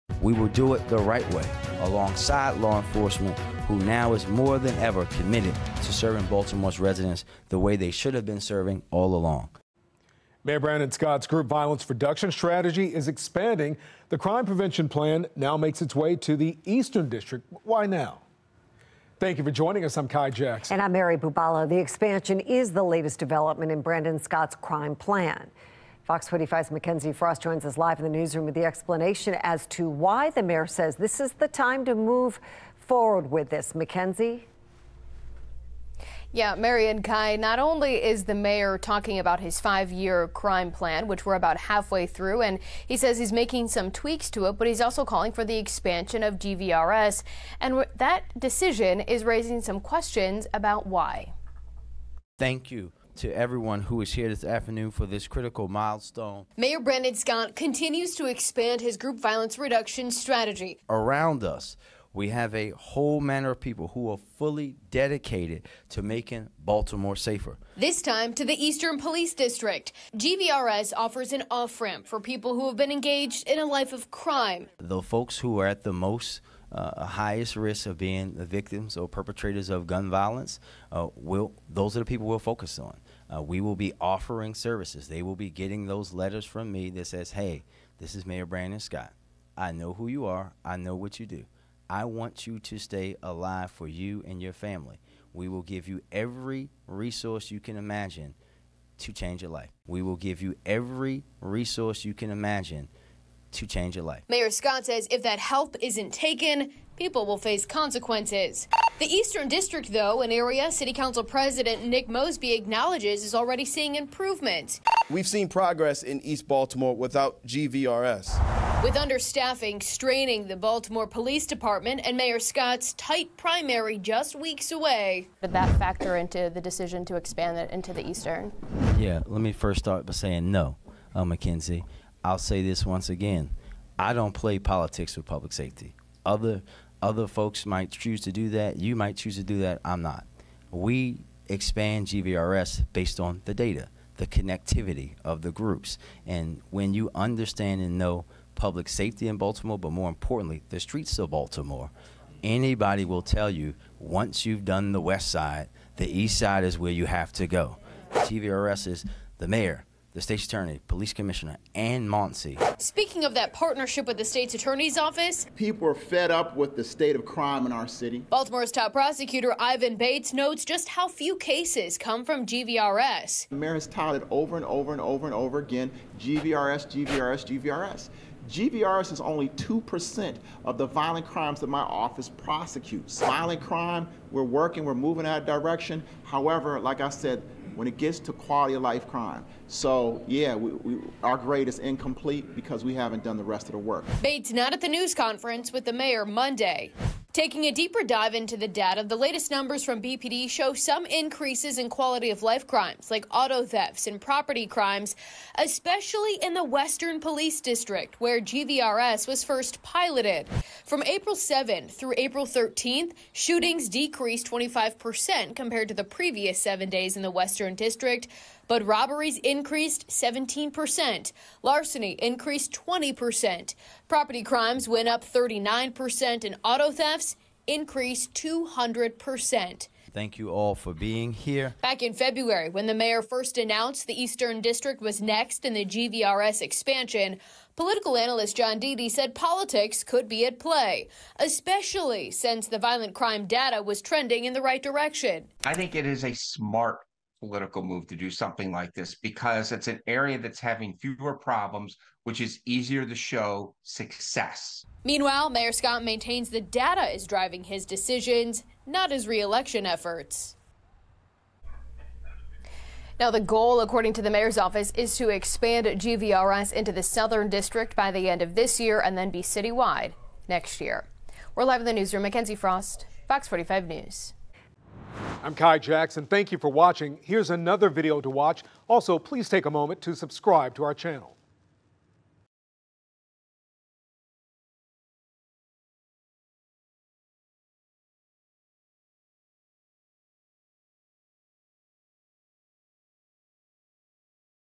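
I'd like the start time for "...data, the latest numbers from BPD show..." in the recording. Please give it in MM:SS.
03:18.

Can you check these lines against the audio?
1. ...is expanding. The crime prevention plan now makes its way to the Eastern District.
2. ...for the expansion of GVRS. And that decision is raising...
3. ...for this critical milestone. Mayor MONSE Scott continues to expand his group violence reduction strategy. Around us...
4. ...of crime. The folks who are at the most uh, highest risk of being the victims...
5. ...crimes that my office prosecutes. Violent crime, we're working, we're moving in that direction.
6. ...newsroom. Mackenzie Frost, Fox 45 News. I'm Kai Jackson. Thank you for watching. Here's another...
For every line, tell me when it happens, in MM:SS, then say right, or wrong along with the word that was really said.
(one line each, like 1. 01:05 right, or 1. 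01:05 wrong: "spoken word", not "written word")
1. 00:12 right
2. 00:45 right
3. 00:54 wrong: "Brandon", not "MONSE"
4. 01:13 right
5. 03:01 right
6. 04:31 right.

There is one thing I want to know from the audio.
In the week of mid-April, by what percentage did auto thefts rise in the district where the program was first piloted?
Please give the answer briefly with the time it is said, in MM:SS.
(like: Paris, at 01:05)
200%, at 03:48.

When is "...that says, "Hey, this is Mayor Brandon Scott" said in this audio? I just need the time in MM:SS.
01:26.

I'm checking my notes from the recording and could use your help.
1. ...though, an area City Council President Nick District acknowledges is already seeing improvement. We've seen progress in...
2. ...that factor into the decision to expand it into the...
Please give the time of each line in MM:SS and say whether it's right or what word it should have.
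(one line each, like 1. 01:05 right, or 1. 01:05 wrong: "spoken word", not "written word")
1. 01:49 wrong: "Mosby", not "District"
2. 02:05 right.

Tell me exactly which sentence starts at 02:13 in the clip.
I don't play politics with public safety.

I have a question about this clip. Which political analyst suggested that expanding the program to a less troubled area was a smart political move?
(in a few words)
John Dedie.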